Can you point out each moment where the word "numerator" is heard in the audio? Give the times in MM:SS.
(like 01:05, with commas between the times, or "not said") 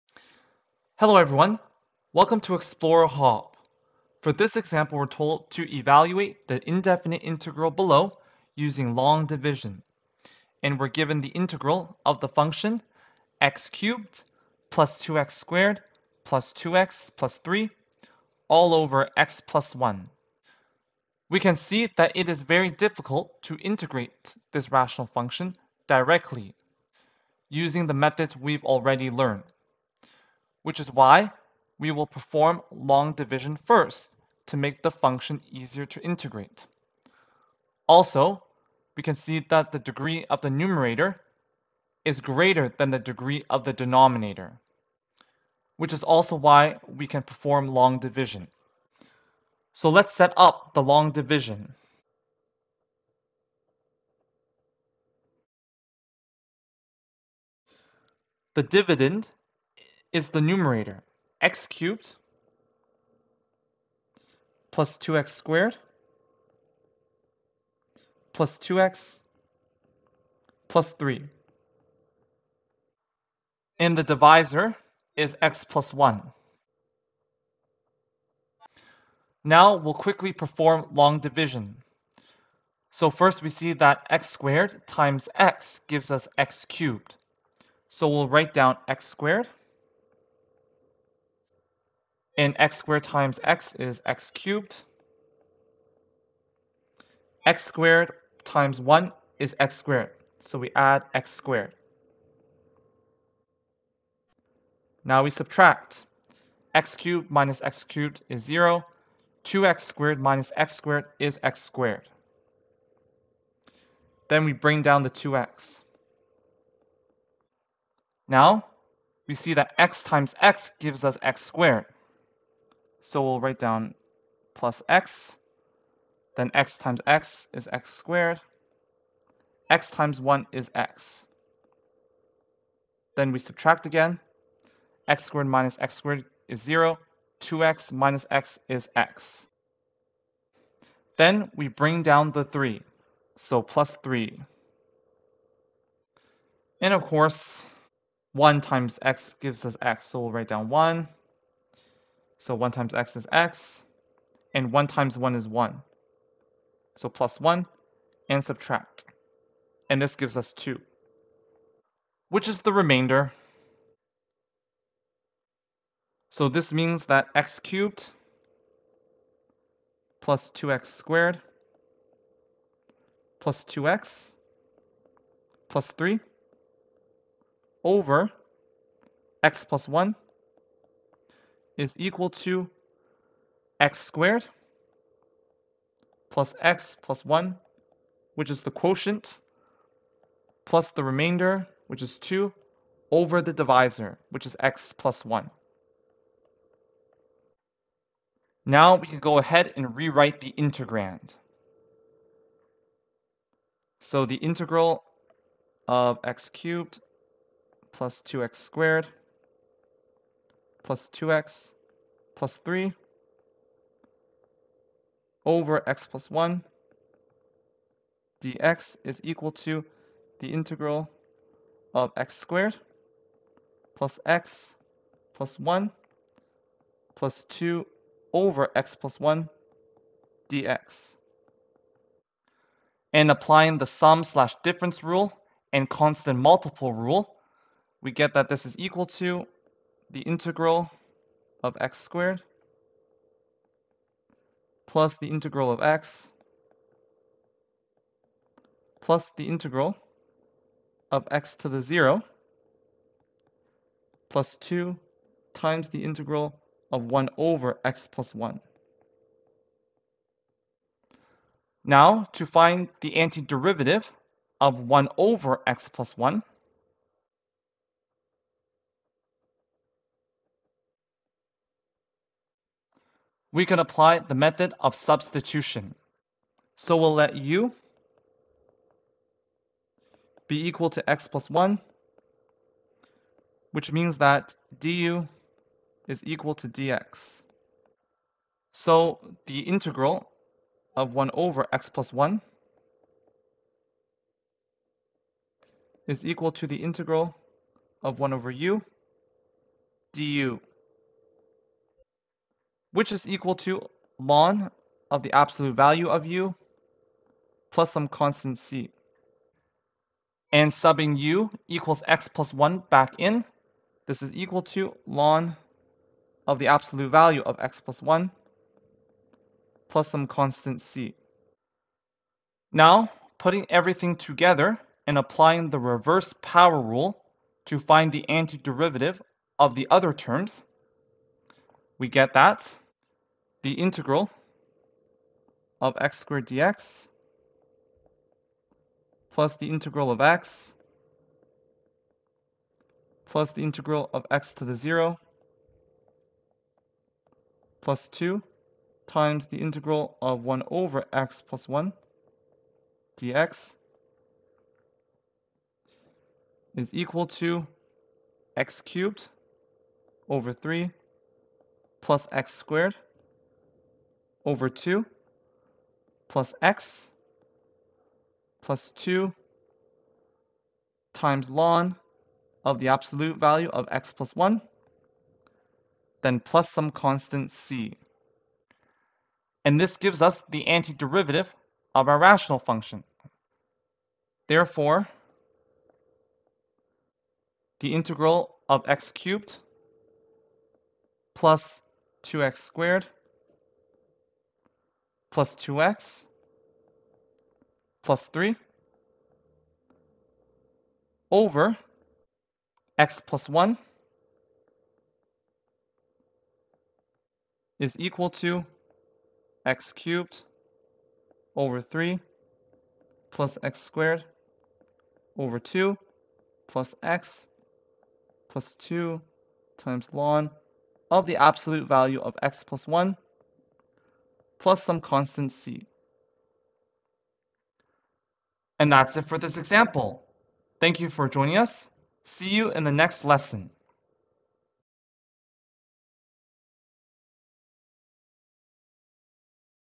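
00:40, 01:00.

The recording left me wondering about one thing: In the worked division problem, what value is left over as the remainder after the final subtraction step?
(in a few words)
2.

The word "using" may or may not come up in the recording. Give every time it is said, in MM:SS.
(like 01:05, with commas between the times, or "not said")
00:08, 00:27.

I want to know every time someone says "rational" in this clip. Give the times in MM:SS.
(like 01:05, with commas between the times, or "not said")
00:24, 06:22.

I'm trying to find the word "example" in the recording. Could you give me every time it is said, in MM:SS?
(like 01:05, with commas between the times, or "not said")
00:04, 07:09.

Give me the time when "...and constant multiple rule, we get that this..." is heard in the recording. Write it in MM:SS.
03:55.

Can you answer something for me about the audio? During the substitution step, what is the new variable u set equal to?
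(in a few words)
x plus 1.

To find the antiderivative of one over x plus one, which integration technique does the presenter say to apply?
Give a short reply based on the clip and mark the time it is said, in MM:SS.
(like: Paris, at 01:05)
method of substitution, at 04:34.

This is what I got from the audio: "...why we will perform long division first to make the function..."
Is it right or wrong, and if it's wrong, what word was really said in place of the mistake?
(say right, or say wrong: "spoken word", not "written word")
right.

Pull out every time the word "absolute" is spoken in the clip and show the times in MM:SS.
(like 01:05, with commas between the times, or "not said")
05:05, 05:16, 06:12, 07:01.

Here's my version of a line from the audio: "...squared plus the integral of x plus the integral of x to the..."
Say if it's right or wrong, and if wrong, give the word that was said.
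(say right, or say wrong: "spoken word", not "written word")
right.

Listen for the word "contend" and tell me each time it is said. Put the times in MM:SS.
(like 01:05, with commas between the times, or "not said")
not said.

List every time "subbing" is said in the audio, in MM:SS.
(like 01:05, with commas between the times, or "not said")
05:10.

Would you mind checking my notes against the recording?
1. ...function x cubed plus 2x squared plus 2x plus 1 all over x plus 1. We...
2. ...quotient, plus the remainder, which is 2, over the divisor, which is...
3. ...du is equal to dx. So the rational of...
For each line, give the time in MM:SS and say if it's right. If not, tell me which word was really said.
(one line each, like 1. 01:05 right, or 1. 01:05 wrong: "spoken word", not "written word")
1. 00:12 wrong: "3", not "1"
2. 03:08 right
3. 04:44 wrong: "integral", not "rational".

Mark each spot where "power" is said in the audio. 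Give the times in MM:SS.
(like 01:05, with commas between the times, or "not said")
05:26.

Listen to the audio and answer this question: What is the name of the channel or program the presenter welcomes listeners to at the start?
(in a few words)
Explorer Hop.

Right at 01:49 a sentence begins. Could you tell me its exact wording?
2x squared minus x squared is x squared.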